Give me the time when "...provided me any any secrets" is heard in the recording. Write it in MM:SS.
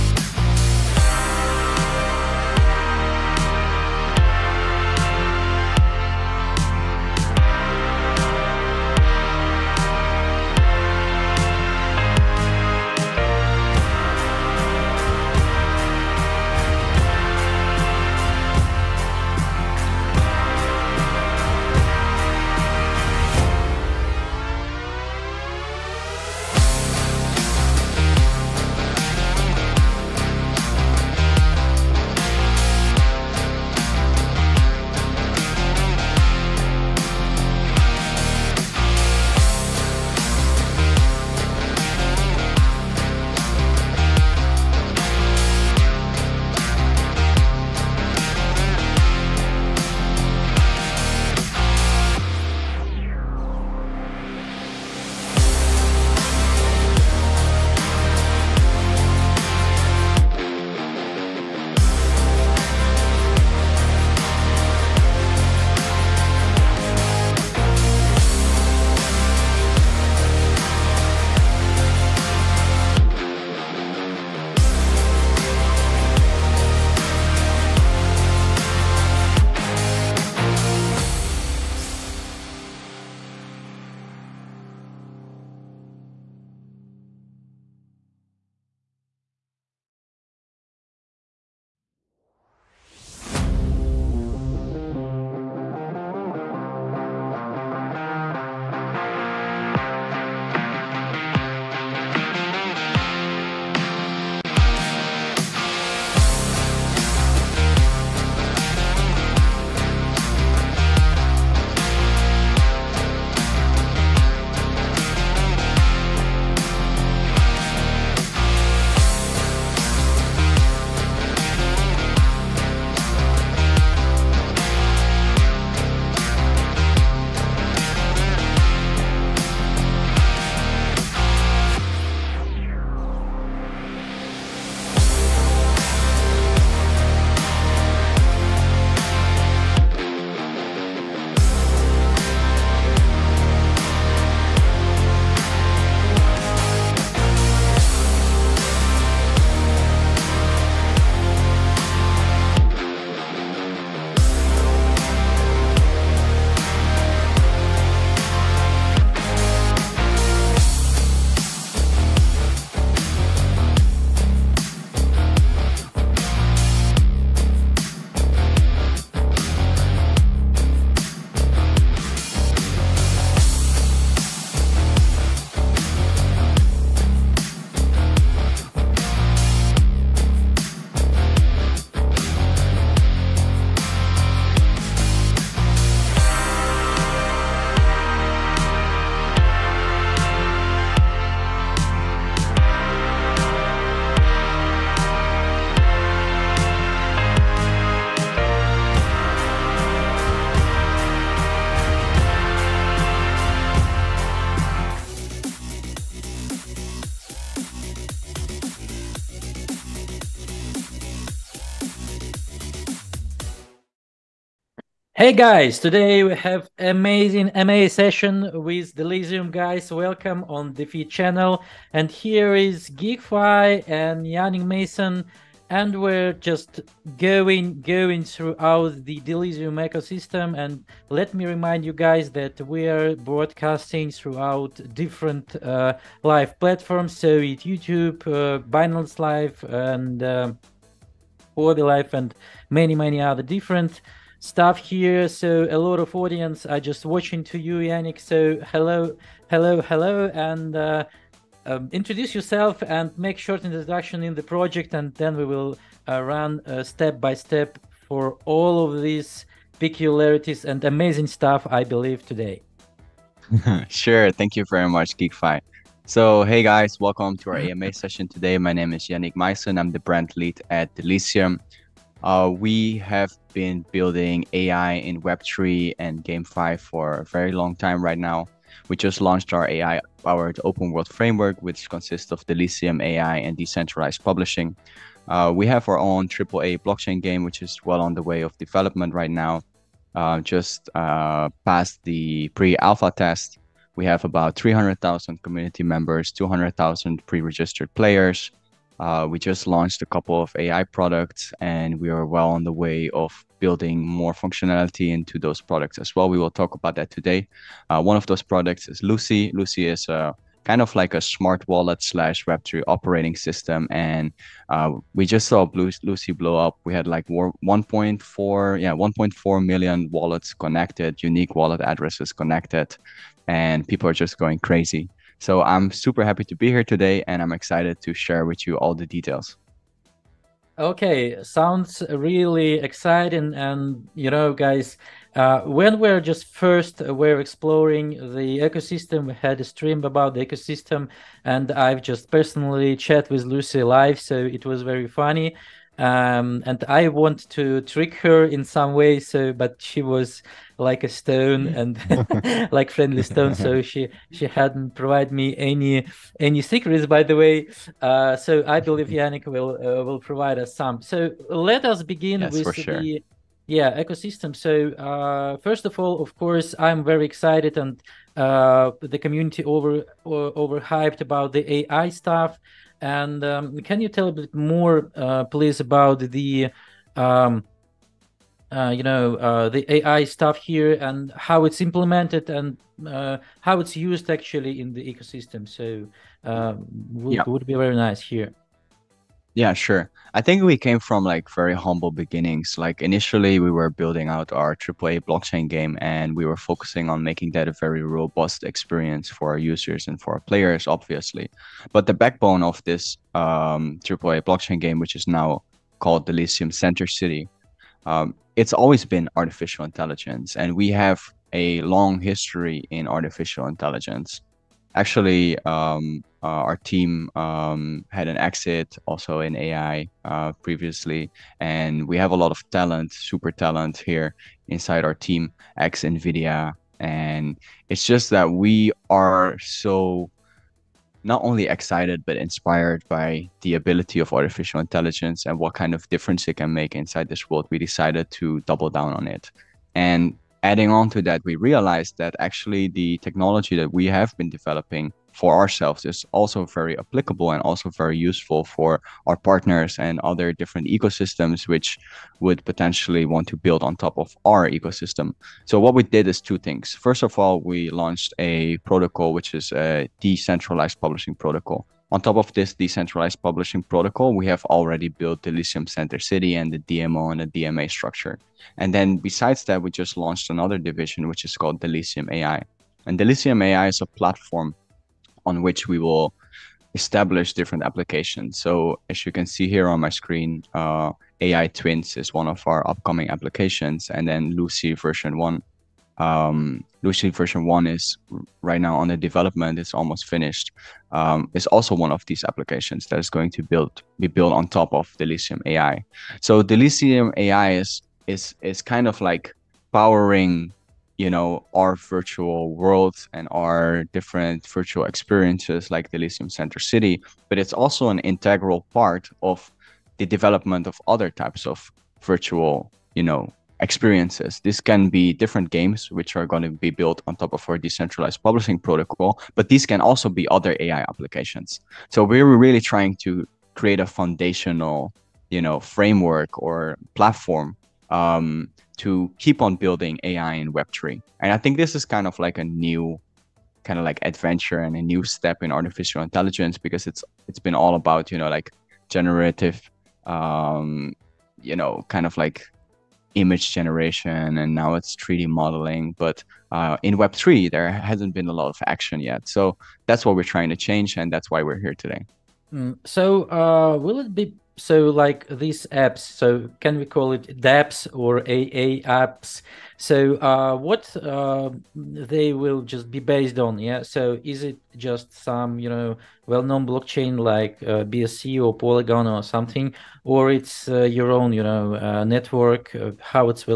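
05:54.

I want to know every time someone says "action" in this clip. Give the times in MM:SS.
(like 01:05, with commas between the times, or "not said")
09:08.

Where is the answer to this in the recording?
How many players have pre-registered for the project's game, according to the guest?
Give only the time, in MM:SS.
04:56.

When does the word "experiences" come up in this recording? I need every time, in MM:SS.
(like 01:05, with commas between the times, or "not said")
06:38, 08:25, 08:33.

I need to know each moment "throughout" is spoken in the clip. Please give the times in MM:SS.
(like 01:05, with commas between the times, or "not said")
03:48, 03:54.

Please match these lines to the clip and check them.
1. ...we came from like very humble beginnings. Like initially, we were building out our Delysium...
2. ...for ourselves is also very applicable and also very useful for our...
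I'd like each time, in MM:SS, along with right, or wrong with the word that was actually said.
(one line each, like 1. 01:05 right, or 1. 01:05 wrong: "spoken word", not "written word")
1. 06:30 wrong: "AAA", not "Delysium"
2. 07:25 right.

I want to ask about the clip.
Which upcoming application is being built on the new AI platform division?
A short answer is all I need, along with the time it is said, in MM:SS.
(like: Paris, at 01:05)
AI Twins, at 08:01.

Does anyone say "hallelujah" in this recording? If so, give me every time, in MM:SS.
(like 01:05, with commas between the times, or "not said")
not said.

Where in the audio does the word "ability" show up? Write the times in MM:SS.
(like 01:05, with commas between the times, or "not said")
07:13.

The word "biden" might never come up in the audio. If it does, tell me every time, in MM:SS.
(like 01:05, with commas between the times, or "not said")
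not said.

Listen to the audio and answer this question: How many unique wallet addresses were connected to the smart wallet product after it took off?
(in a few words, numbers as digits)
1.4 million.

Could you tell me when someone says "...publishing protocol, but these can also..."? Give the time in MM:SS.
08:38.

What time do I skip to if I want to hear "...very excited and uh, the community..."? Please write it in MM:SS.
06:07.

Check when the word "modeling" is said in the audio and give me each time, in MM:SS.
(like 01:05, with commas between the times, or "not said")
09:05.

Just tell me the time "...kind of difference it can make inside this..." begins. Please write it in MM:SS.
07:15.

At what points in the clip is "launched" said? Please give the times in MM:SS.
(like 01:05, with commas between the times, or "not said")
04:39, 04:59, 07:37, 07:50.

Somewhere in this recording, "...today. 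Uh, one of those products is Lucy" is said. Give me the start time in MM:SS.
05:07.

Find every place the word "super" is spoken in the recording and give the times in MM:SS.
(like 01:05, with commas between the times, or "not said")
05:25, 07:03.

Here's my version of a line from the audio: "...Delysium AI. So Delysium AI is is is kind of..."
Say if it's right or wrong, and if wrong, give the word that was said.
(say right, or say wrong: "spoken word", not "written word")
right.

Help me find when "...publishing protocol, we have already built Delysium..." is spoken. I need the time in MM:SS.
07:43.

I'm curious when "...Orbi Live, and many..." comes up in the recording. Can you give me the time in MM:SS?
04:01.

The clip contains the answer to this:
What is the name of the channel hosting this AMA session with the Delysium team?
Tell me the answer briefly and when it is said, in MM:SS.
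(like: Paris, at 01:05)
DeFeed, at 03:40.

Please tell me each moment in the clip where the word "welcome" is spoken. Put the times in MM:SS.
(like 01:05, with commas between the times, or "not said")
03:39, 04:26.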